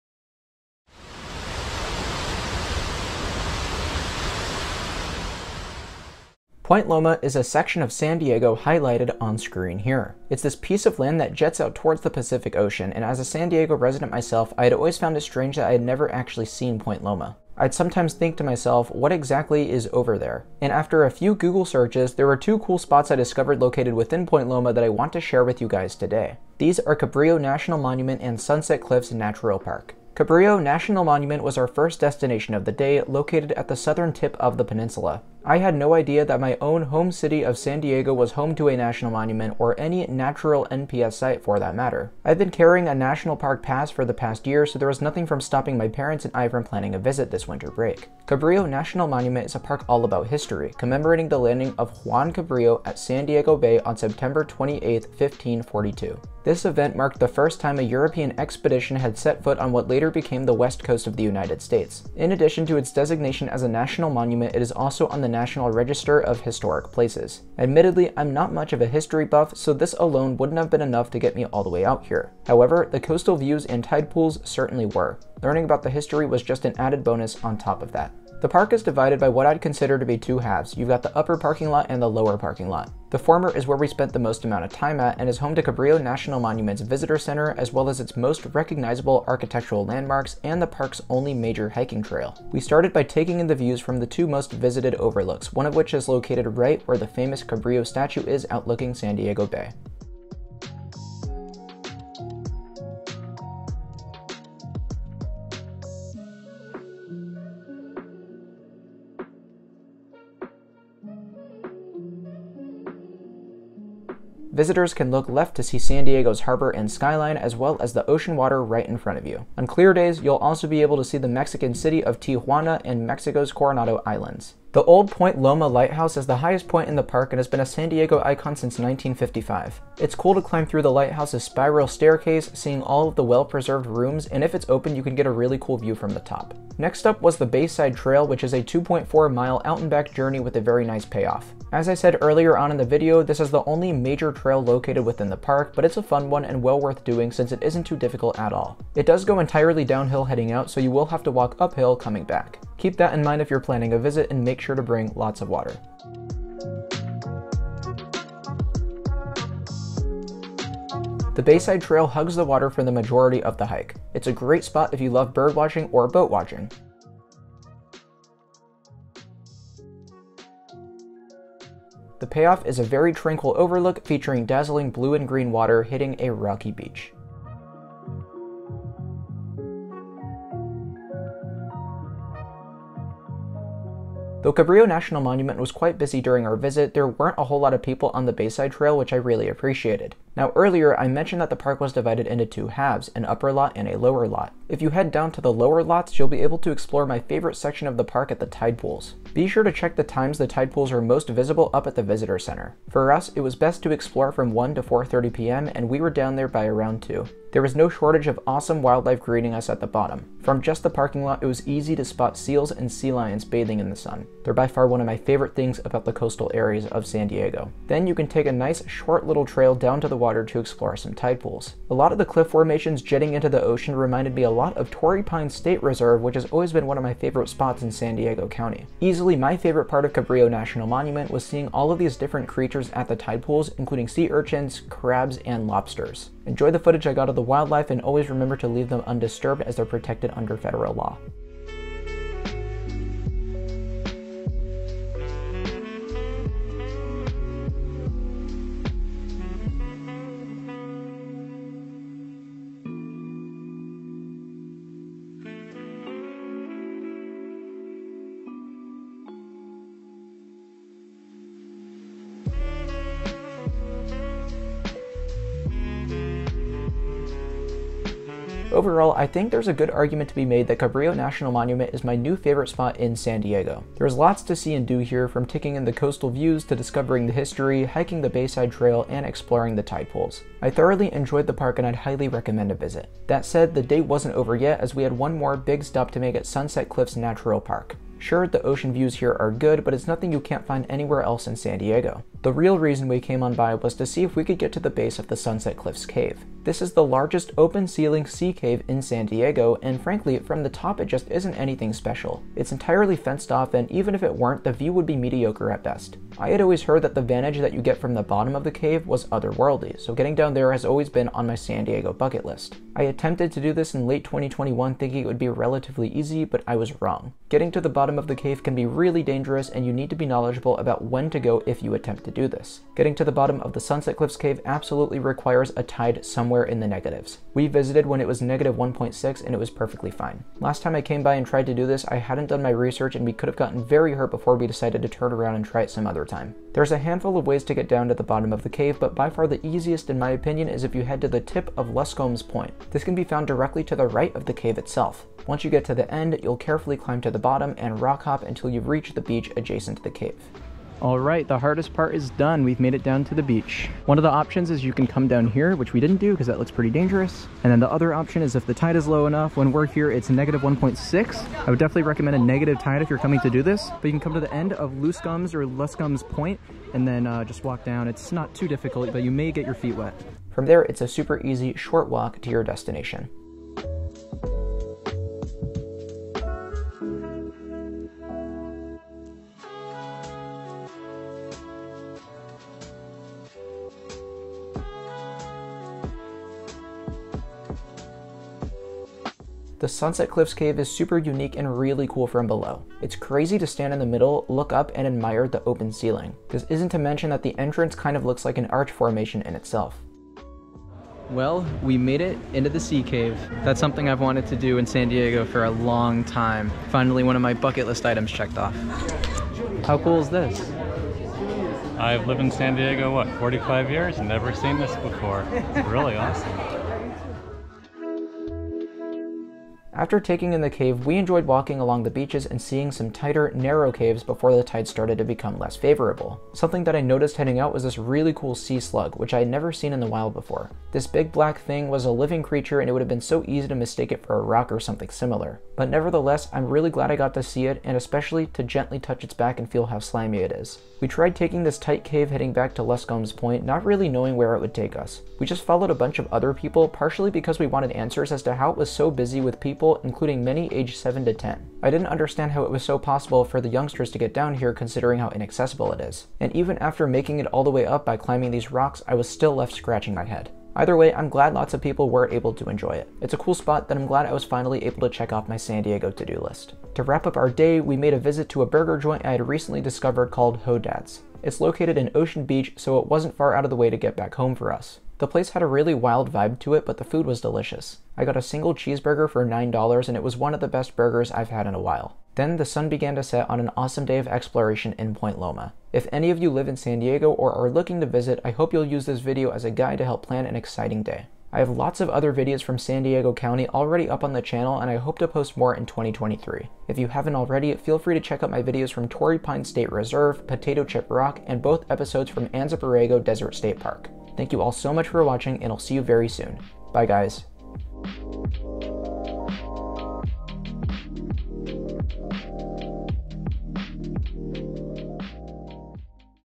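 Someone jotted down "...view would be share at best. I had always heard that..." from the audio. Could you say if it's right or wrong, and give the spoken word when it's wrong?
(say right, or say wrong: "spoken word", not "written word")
wrong: "mediocre", not "share".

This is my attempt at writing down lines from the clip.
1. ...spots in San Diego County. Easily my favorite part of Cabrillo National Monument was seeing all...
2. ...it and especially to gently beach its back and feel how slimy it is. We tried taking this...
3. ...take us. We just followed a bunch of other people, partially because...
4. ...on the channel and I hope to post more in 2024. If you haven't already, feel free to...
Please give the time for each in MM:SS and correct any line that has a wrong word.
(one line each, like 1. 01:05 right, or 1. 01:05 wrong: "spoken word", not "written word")
1. 03:47 right
2. 07:17 wrong: "touch", not "beach"
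3. 07:24 right
4. 08:14 wrong: "2023", not "2024".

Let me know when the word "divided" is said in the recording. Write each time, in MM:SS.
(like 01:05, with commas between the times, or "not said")
01:18, 03:11.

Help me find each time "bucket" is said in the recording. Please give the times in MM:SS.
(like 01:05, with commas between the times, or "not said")
05:12, 06:47.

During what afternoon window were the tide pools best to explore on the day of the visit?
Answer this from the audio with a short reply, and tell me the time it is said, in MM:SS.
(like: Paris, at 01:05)
1 to 4:30 p.m., at 03:24.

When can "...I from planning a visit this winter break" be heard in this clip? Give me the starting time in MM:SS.
00:46.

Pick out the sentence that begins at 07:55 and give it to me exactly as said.
The place had a really wild vibe to it, but the food was delicious.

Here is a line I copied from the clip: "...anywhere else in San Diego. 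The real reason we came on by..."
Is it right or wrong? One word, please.
right.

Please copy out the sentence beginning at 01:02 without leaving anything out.
In addition to its designation as a national monument, it is also on the National Register of Historic Places.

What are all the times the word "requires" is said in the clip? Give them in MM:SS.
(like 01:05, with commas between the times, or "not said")
05:25.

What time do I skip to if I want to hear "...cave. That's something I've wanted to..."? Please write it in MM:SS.
06:43.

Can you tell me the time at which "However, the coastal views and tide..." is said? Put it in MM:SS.
01:12.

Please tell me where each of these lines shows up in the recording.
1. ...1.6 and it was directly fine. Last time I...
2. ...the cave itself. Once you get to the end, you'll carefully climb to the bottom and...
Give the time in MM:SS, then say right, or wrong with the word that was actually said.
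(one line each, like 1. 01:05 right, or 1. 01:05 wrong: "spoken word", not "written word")
1. 05:28 wrong: "perfectly", not "directly"
2. 05:44 right.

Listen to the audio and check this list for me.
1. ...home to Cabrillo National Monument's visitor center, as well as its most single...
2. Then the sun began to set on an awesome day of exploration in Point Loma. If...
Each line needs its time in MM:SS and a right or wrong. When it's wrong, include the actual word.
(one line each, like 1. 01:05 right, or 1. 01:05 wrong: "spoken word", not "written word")
1. 01:25 wrong: "recognizable", not "single"
2. 08:02 right.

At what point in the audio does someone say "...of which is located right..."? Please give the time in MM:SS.
01:35.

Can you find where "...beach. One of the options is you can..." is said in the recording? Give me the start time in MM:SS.
05:53.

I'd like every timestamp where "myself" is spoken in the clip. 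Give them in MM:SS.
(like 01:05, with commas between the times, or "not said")
00:14, 00:18.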